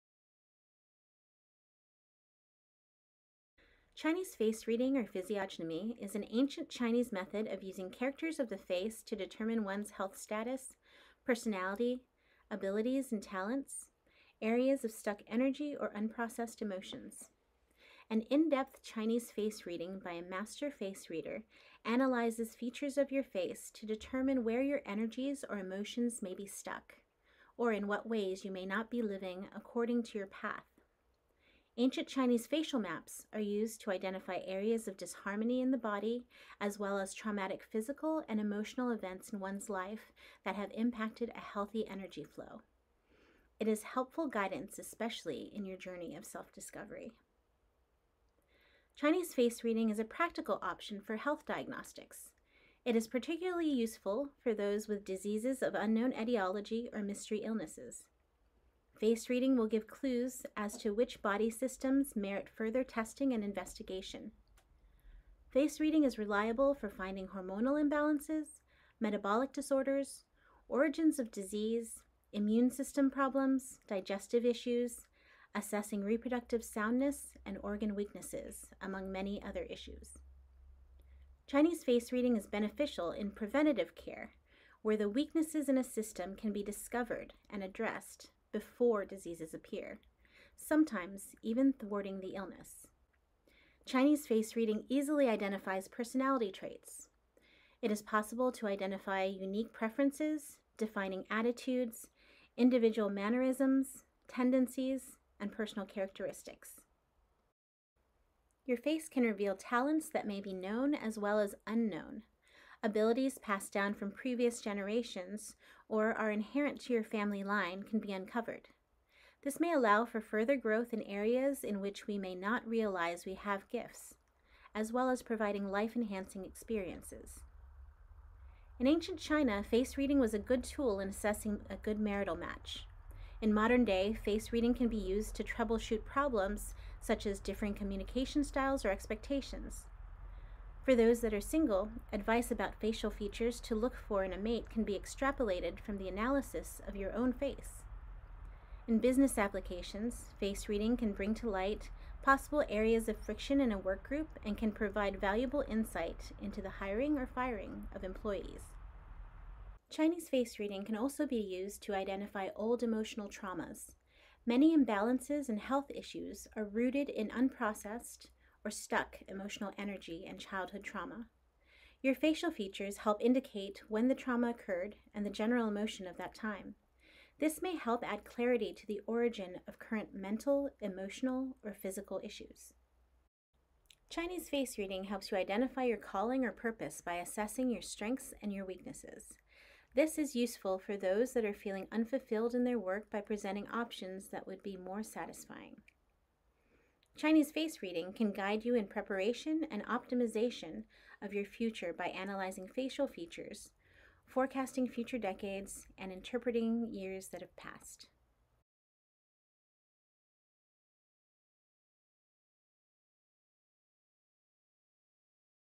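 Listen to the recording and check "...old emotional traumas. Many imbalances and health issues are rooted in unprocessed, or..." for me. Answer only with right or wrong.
right.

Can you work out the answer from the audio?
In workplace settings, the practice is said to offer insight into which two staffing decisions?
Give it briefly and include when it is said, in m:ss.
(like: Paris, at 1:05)
Hiring or firing, at 2:36.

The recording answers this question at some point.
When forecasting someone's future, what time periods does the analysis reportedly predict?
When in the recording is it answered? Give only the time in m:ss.
3:24.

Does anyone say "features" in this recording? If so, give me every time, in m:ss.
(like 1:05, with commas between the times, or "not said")
0:22, 2:23, 2:52, 3:23.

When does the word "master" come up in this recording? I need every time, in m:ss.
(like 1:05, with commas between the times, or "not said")
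0:20.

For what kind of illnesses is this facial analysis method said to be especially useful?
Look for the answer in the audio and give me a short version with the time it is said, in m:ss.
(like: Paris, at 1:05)
Diseases of unknown etiology, at 0:55.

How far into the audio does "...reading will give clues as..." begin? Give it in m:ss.
0:59.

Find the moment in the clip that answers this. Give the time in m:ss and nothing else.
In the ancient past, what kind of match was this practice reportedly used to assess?
2:11.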